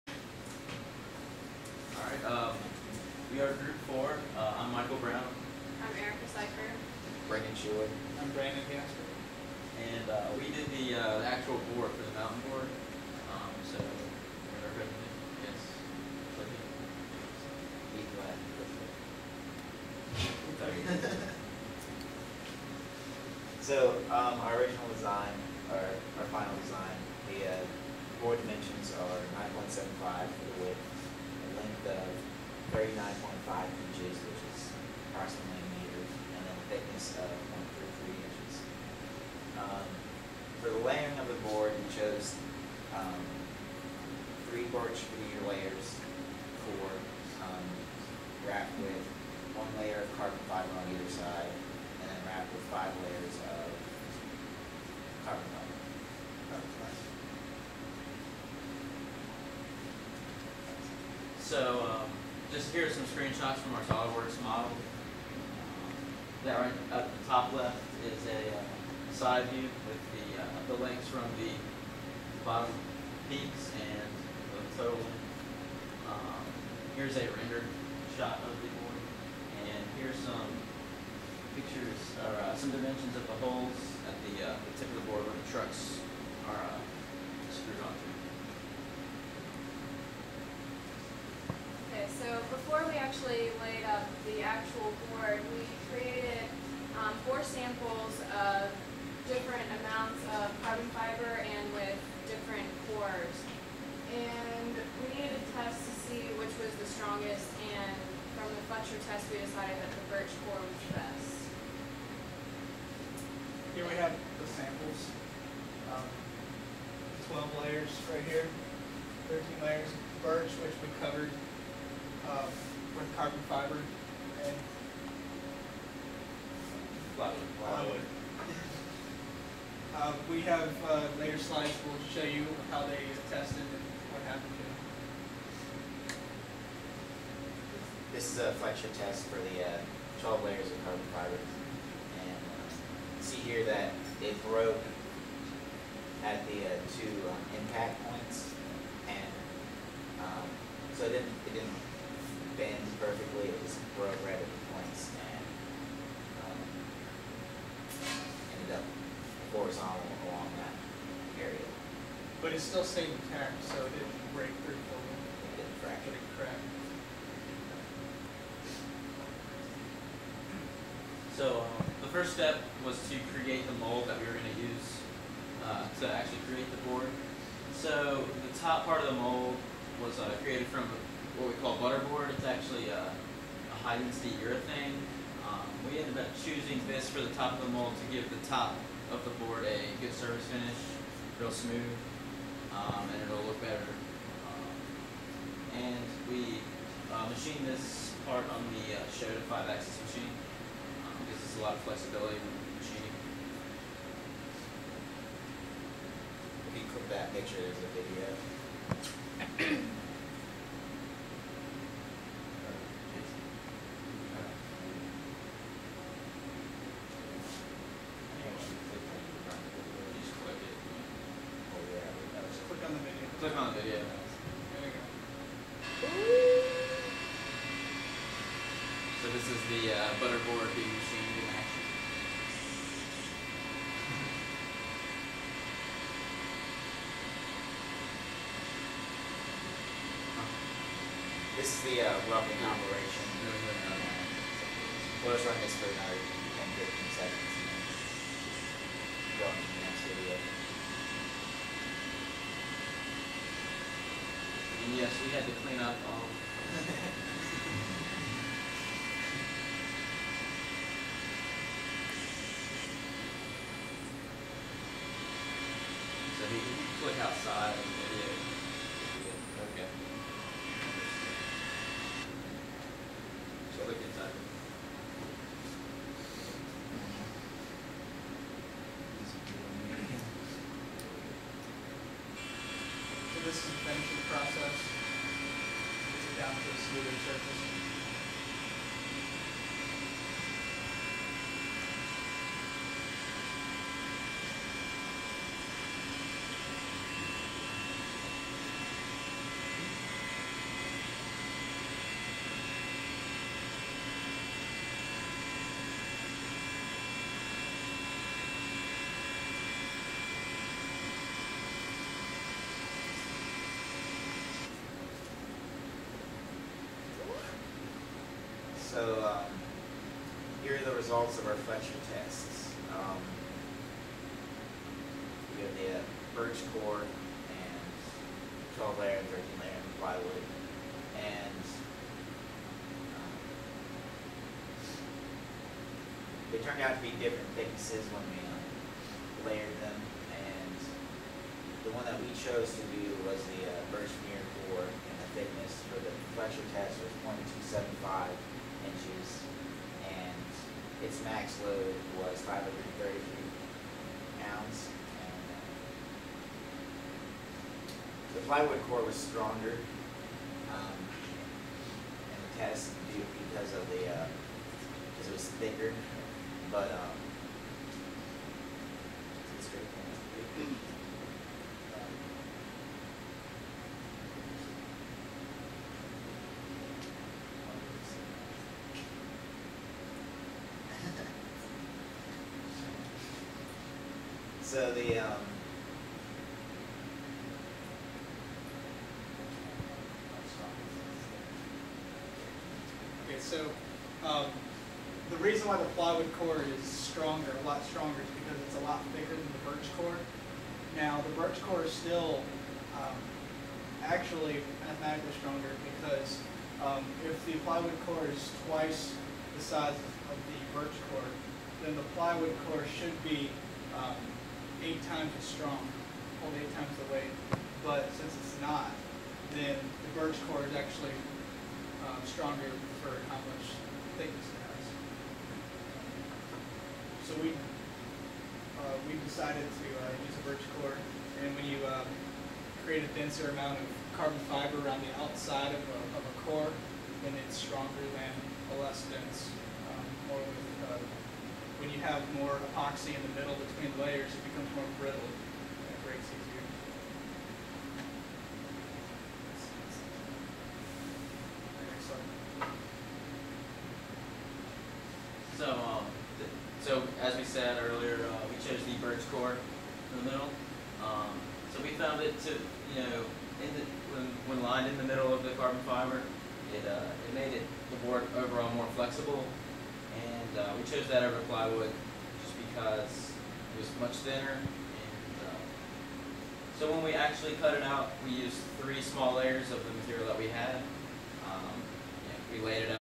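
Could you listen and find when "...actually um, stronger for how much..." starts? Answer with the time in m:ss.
7:00.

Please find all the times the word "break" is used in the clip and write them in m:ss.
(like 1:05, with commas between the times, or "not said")
2:44, 7:26.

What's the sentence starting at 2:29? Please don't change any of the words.
And um, so it didn't, it didn't bends perfectly.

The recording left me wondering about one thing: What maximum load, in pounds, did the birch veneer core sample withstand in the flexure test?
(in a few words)
533 pounds.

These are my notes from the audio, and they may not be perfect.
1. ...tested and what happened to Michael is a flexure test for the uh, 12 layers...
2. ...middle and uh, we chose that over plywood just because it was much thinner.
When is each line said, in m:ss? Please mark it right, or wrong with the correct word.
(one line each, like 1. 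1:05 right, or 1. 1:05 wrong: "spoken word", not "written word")
1. 2:13 wrong: "This", not "Michael"
2. 7:48 wrong: "flexible", not "middle".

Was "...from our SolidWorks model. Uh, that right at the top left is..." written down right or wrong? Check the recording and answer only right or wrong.
right.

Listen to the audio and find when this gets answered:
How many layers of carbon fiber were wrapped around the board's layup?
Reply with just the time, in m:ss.
0:52.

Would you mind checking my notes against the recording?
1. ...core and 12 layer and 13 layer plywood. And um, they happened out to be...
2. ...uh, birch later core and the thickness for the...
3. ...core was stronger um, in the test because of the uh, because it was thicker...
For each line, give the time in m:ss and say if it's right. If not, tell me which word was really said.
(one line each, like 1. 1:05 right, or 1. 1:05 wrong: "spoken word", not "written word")
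1. 5:26 wrong: "turned", not "happened"
2. 5:43 wrong: "veneer", not "later"
3. 5:58 right.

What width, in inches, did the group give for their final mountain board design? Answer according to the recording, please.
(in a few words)
9.75.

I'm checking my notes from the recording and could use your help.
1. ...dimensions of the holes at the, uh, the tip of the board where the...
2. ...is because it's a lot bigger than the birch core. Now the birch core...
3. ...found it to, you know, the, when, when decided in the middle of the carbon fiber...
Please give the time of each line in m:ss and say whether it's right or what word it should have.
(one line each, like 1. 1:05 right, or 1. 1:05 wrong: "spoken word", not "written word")
1. 1:22 right
2. 6:38 right
3. 7:41 wrong: "lined", not "decided".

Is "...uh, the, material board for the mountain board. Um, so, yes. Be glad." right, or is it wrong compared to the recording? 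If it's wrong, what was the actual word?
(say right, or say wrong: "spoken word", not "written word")
wrong: "actual", not "material".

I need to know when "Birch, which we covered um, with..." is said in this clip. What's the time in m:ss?
2:00.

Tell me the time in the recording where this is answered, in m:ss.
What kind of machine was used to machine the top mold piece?
3:19.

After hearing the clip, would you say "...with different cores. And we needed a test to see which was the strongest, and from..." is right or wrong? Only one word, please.
right.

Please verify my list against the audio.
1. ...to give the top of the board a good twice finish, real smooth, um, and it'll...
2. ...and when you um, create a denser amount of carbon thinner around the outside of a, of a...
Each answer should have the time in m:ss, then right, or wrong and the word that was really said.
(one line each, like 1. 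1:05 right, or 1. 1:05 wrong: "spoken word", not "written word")
1. 3:07 wrong: "surface", not "twice"
2. 7:11 wrong: "fiber", not "thinner".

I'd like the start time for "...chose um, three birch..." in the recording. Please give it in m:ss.
0:41.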